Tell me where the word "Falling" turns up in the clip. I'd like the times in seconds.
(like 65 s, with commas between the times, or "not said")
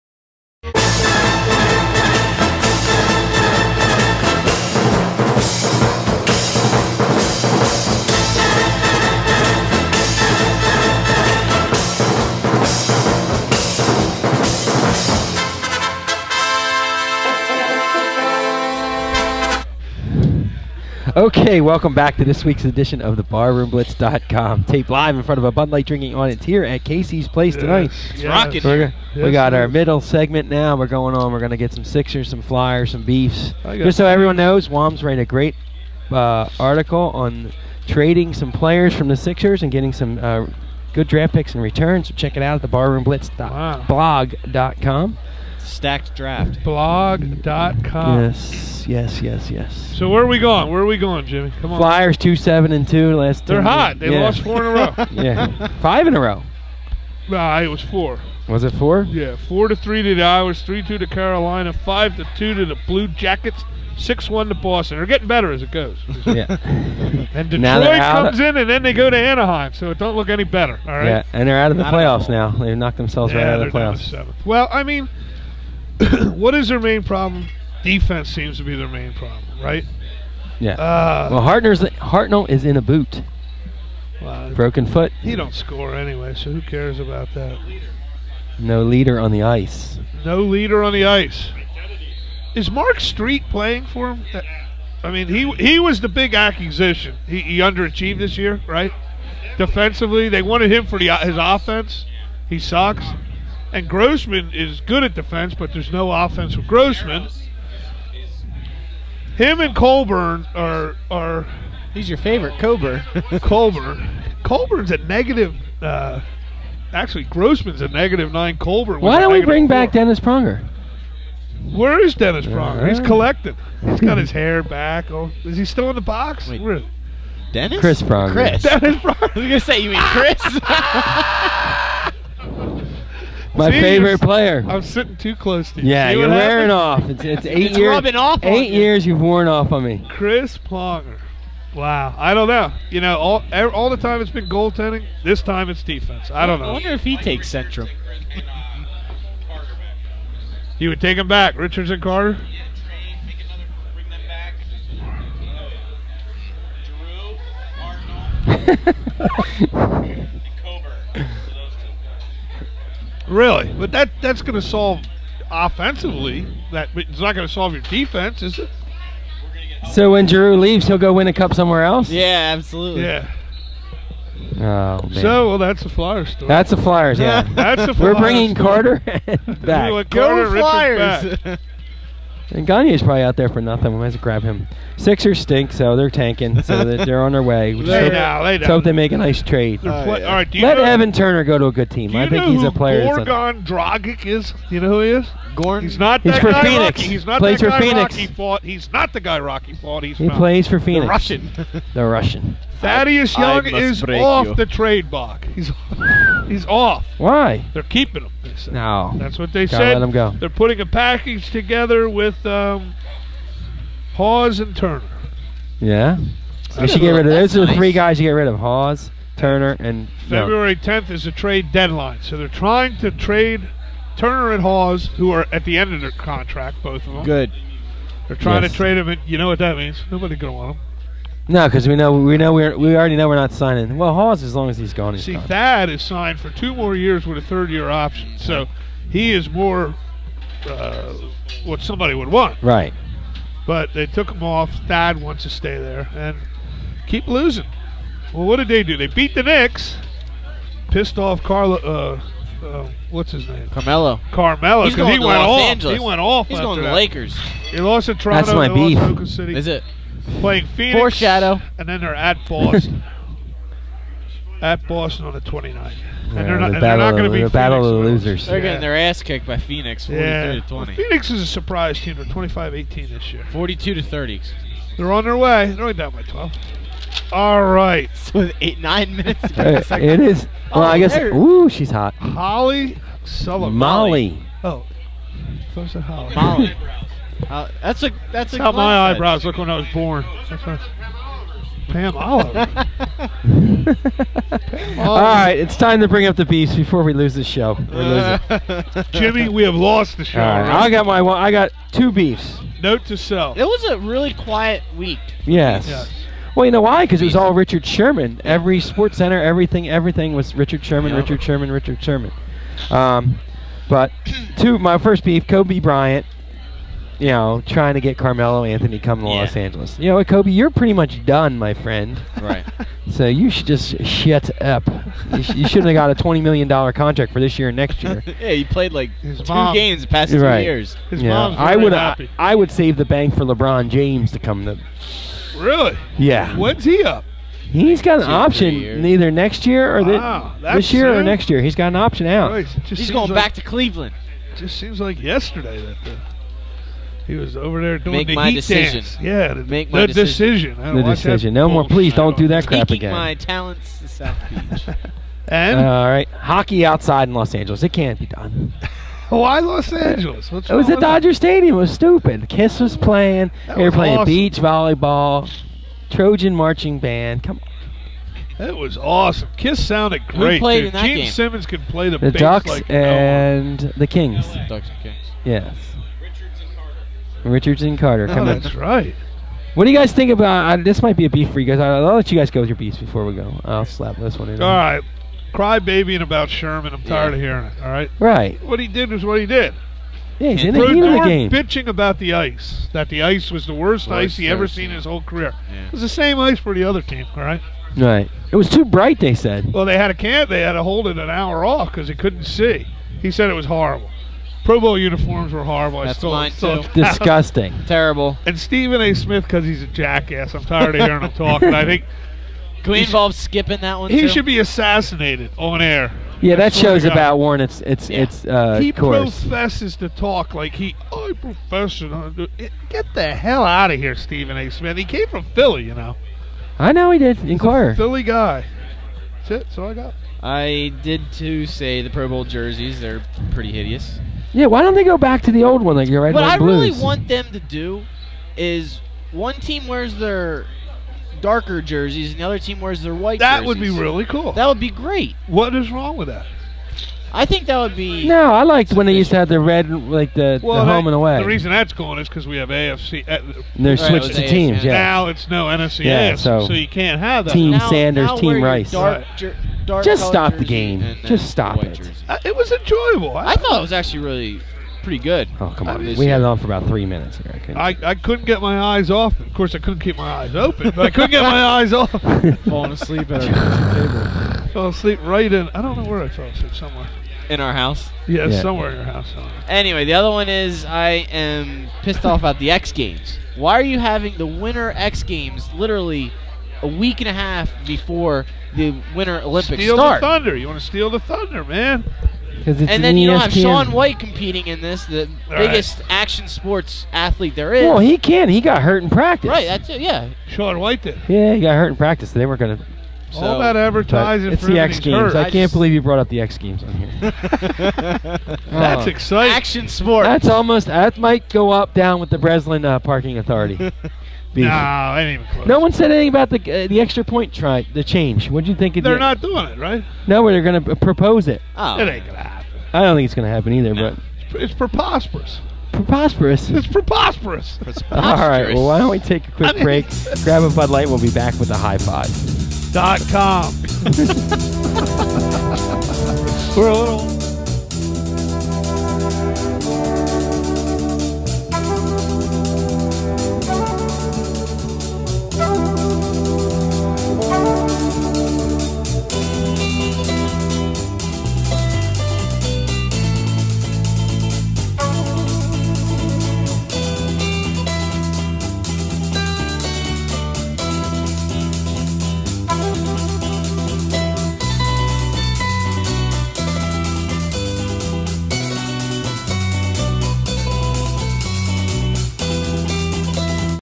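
472 s.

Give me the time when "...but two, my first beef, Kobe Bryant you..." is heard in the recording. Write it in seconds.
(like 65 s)
313 s.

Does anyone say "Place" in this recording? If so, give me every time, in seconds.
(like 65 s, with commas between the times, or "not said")
27 s.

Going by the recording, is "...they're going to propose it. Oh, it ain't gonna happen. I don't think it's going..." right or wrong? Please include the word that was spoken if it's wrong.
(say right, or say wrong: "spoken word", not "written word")
right.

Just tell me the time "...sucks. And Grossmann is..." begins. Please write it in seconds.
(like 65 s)
102 s.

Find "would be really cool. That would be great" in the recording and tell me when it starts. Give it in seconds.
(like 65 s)
443 s.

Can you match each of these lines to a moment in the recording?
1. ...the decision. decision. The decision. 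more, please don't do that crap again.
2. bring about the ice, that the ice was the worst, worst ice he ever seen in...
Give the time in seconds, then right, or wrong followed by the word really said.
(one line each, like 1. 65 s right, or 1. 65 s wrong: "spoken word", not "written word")
1. 350 s right
2. 391 s wrong: "bitching", not "bring".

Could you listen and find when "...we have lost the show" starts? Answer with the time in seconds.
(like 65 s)
299 s.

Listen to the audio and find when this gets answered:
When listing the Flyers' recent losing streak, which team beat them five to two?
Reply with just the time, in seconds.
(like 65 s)
62 s.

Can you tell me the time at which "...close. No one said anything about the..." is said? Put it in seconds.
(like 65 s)
515 s.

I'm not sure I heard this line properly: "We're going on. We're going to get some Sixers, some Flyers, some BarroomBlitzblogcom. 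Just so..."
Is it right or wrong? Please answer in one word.
wrong.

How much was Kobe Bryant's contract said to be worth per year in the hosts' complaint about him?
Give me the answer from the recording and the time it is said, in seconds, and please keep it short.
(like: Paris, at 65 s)
$20 million, at 326 s.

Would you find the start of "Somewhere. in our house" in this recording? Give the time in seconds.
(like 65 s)
476 s.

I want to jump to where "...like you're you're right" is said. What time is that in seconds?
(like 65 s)
435 s.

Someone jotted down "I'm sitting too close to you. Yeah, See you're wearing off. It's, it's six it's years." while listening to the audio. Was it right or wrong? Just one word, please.
wrong.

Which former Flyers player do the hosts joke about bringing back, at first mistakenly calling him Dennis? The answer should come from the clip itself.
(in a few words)
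Chris Pronger.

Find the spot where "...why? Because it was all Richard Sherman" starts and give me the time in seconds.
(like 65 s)
306 s.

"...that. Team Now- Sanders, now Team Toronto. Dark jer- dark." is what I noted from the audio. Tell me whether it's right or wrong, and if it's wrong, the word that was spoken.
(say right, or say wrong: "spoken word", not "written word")
wrong: "Rice", not "Toronto".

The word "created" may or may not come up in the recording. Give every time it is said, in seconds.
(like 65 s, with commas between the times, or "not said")
not said.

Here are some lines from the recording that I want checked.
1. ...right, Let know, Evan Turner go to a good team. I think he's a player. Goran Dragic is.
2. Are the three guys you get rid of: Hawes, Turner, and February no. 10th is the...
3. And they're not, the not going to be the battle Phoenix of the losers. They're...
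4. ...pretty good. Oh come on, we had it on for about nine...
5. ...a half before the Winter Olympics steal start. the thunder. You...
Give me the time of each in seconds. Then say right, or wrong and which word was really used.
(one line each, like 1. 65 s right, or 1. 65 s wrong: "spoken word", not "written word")
1. 190 s right
2. 217 s right
3. 266 s right
4. 465 s wrong: "three", not "nine"
5. 487 s right.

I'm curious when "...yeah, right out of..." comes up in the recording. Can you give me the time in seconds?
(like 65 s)
73 s.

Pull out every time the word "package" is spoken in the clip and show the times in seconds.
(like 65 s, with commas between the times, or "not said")
210 s.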